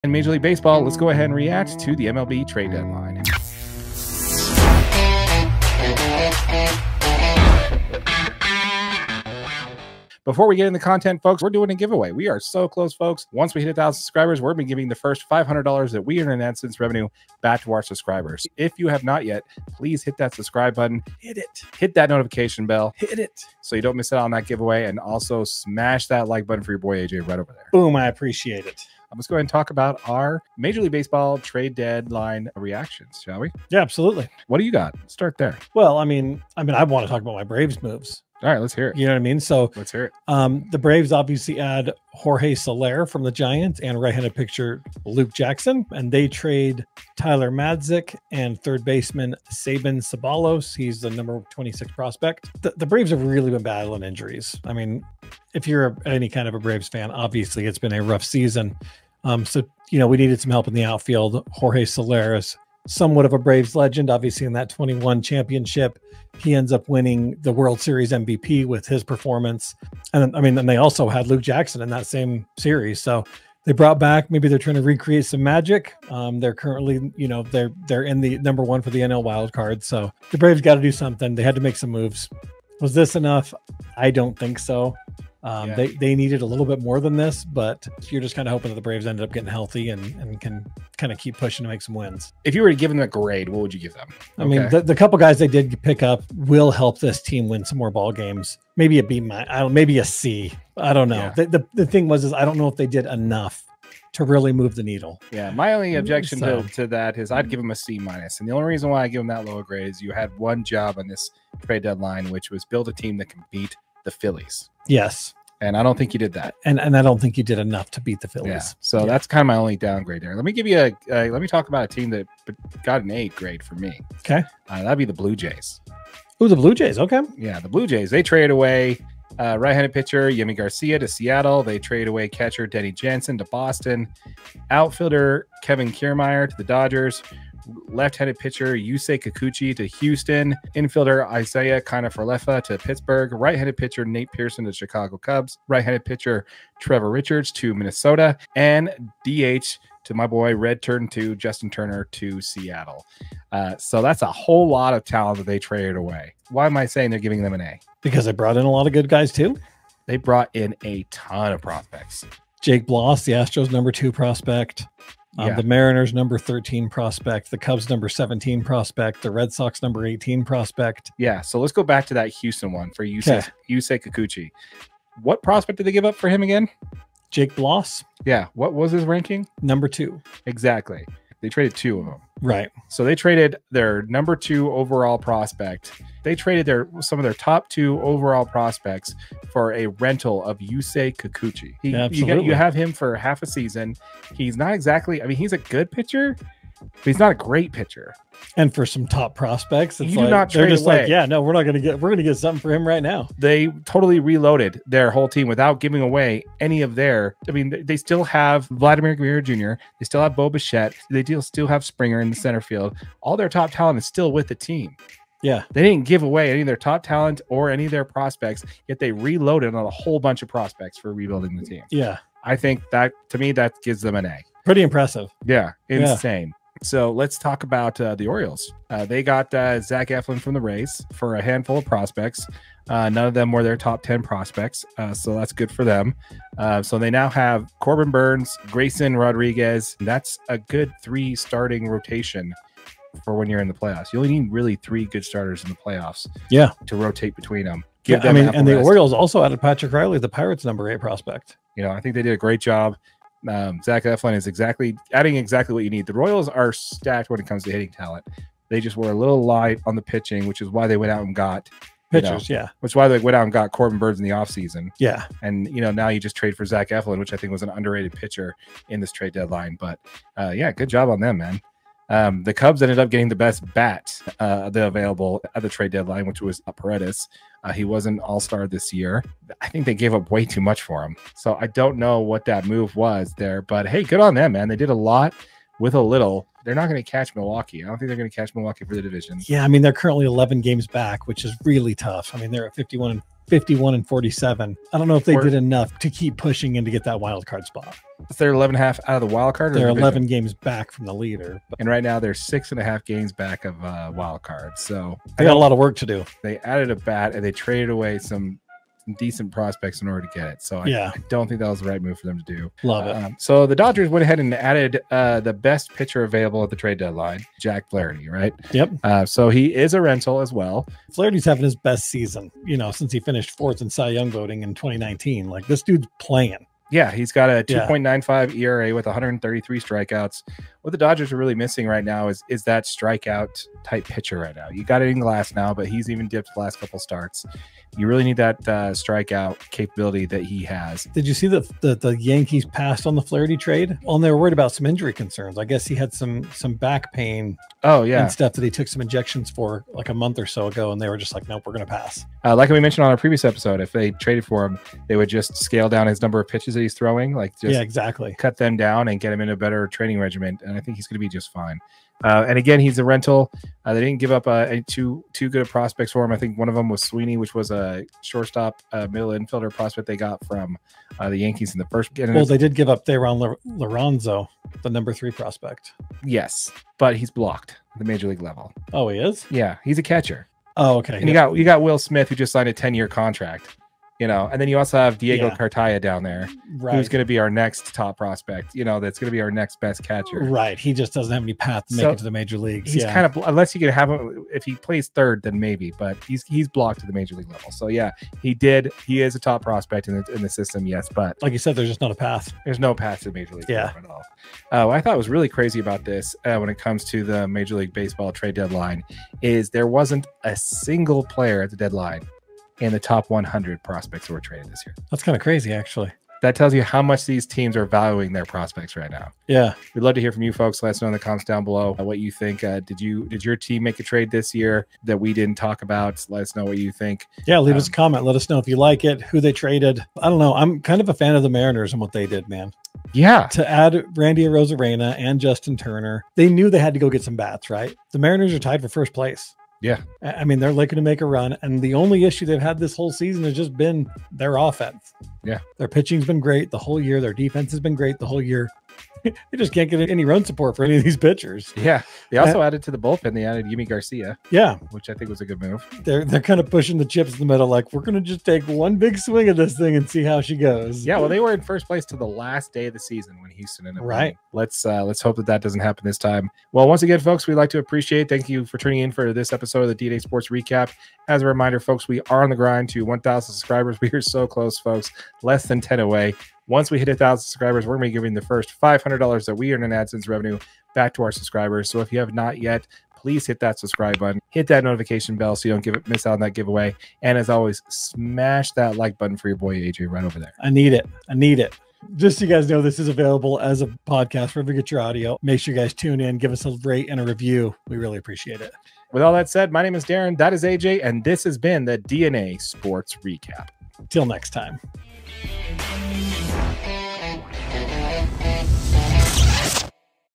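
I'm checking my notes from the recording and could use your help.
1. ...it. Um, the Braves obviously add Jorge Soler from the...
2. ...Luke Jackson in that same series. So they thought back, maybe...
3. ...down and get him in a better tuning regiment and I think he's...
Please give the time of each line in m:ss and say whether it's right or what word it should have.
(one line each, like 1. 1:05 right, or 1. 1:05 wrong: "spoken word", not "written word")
1. 0:40 right
2. 1:11 wrong: "brought", not "thought"
3. 5:58 wrong: "training", not "tuning".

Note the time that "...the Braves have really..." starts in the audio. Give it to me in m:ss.
0:52.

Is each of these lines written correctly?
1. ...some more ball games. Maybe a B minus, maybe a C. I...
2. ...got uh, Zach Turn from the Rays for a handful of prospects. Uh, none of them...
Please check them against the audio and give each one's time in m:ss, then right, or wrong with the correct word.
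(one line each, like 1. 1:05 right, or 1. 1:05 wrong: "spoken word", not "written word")
1. 1:37 right
2. 3:49 wrong: "Eflin", not "Turn".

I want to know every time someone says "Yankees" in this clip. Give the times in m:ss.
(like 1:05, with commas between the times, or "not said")
5:42, 6:11.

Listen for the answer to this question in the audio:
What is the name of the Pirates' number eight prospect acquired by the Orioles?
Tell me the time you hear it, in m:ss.
4:09.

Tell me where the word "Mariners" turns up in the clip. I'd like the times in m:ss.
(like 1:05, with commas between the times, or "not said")
2:45, 7:11, 7:18.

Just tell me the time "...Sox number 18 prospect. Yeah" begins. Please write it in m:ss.
2:49.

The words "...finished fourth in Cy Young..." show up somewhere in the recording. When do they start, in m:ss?
5:23.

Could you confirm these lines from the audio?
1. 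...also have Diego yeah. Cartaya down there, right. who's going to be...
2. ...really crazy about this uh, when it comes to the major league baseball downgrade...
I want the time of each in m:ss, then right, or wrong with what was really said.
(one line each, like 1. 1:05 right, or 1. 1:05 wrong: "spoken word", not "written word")
1. 6:24 right
2. 6:45 wrong: "trade", not "downgrade".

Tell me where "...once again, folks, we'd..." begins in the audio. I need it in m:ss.
7:46.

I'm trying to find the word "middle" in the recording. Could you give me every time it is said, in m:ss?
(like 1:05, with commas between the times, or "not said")
6:09, 7:37.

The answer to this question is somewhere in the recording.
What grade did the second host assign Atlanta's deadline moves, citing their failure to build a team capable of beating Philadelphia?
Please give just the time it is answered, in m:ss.
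1:47.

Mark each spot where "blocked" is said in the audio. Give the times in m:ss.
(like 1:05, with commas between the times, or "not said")
6:17, 6:36.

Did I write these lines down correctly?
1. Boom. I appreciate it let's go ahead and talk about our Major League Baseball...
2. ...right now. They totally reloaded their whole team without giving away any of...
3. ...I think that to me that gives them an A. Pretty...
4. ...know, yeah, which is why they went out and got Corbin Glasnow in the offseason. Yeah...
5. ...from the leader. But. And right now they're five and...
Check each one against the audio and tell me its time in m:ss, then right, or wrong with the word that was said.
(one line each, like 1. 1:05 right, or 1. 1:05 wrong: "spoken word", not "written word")
1. 0:27 right
2. 3:22 right
3. 3:42 right
4. 4:22 wrong: "Burnes", not "Glasnow"
5. 5:00 wrong: "six", not "five".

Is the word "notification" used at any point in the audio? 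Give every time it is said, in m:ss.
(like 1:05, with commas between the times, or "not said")
0:22, 8:04.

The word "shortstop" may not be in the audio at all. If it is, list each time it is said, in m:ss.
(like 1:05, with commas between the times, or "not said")
6:08.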